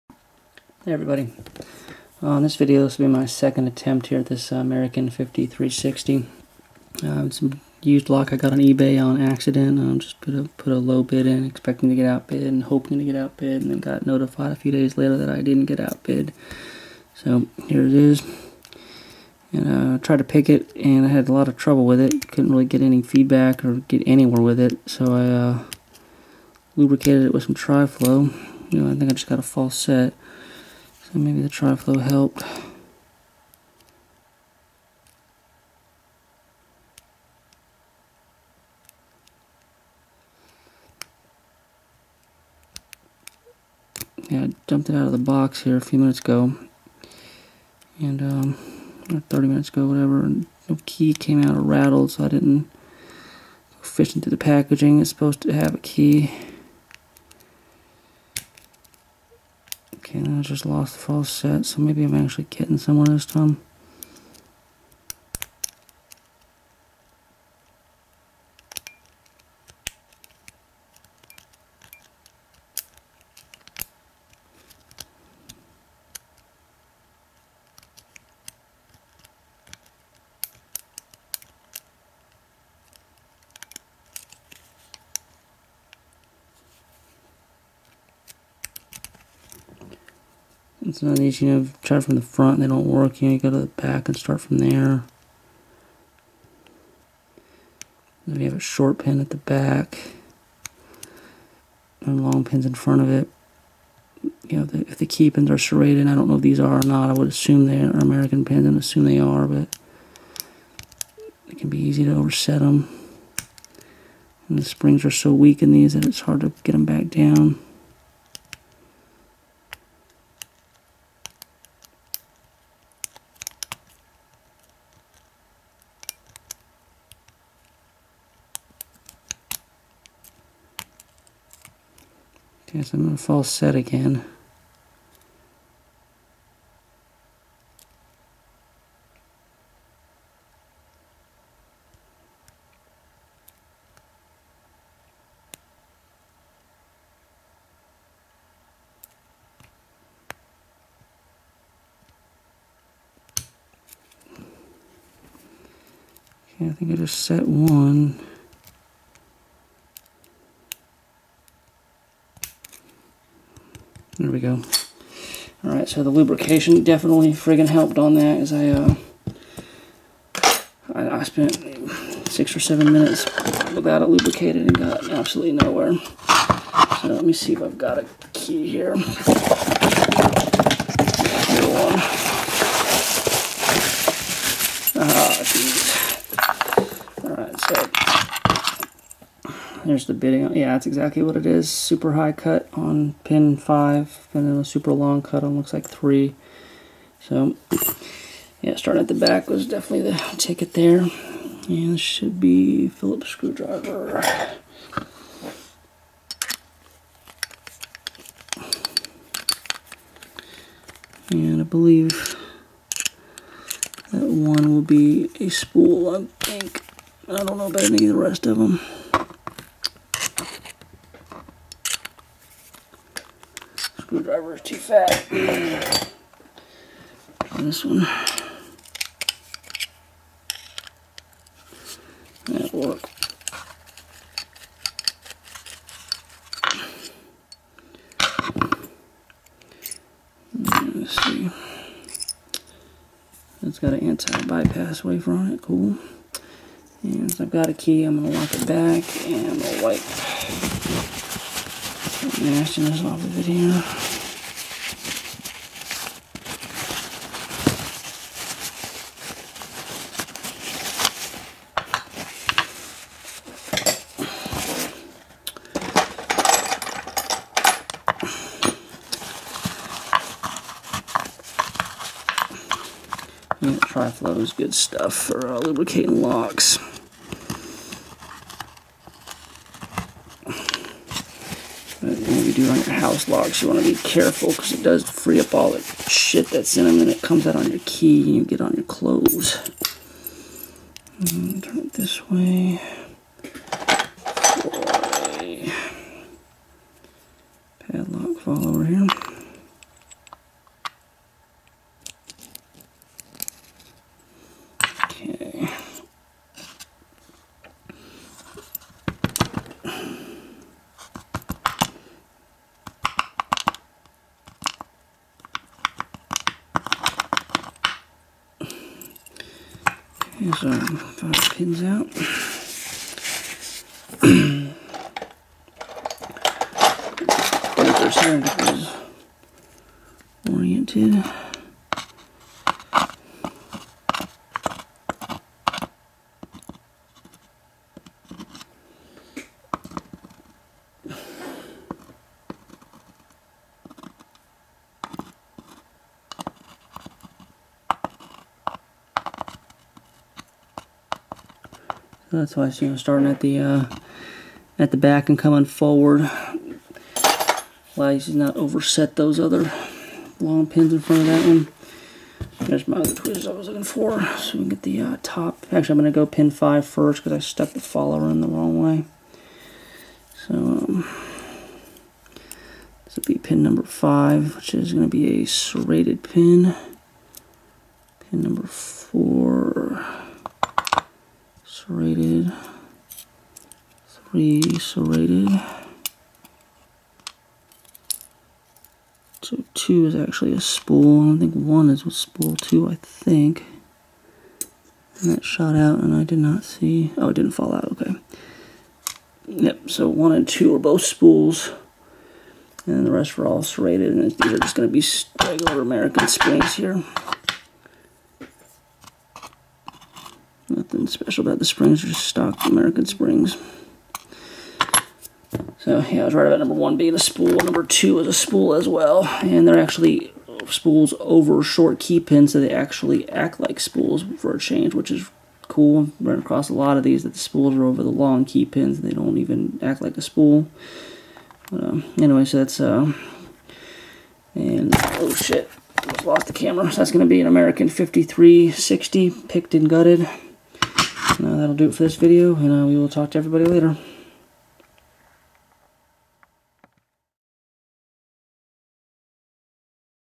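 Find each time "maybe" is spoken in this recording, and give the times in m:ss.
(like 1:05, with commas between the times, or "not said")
0:31, 1:01.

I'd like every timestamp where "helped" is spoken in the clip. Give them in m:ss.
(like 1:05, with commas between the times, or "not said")
0:31, 2:47.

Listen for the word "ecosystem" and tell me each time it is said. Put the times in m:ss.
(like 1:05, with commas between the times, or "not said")
not said.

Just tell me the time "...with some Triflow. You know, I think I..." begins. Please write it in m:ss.
0:27.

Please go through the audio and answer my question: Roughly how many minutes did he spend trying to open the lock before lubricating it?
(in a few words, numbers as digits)
6 or 7.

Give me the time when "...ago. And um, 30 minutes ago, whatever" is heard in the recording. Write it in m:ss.
0:46.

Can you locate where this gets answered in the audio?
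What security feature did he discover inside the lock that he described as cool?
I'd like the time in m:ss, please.
4:04.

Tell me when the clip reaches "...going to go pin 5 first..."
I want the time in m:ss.
6:05.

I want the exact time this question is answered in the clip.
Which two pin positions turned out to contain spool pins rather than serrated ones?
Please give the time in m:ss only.
6:40.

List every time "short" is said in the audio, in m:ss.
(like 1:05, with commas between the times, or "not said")
1:38, 7:01.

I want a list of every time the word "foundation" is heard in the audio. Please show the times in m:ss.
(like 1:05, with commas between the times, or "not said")
not said.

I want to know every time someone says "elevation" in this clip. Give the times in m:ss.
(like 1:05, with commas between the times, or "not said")
not said.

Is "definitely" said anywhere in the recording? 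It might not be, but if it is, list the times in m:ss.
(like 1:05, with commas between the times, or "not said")
2:46, 3:19.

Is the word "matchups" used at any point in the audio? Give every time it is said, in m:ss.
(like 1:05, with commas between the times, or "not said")
not said.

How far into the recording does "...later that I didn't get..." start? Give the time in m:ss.
0:14.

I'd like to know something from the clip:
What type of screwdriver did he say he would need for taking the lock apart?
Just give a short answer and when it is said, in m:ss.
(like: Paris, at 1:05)
Phillips, at 3:22.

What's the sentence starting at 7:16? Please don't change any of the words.
So that's gonna be an American 5360 picked and gutted.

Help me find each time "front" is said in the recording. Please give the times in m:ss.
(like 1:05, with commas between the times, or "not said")
1:32, 1:42, 6:01.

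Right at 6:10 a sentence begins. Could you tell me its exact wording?
So um, this will be pin number 5, which is going to be a serrated pin.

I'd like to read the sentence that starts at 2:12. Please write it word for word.
Okay, so I'm going to false set again.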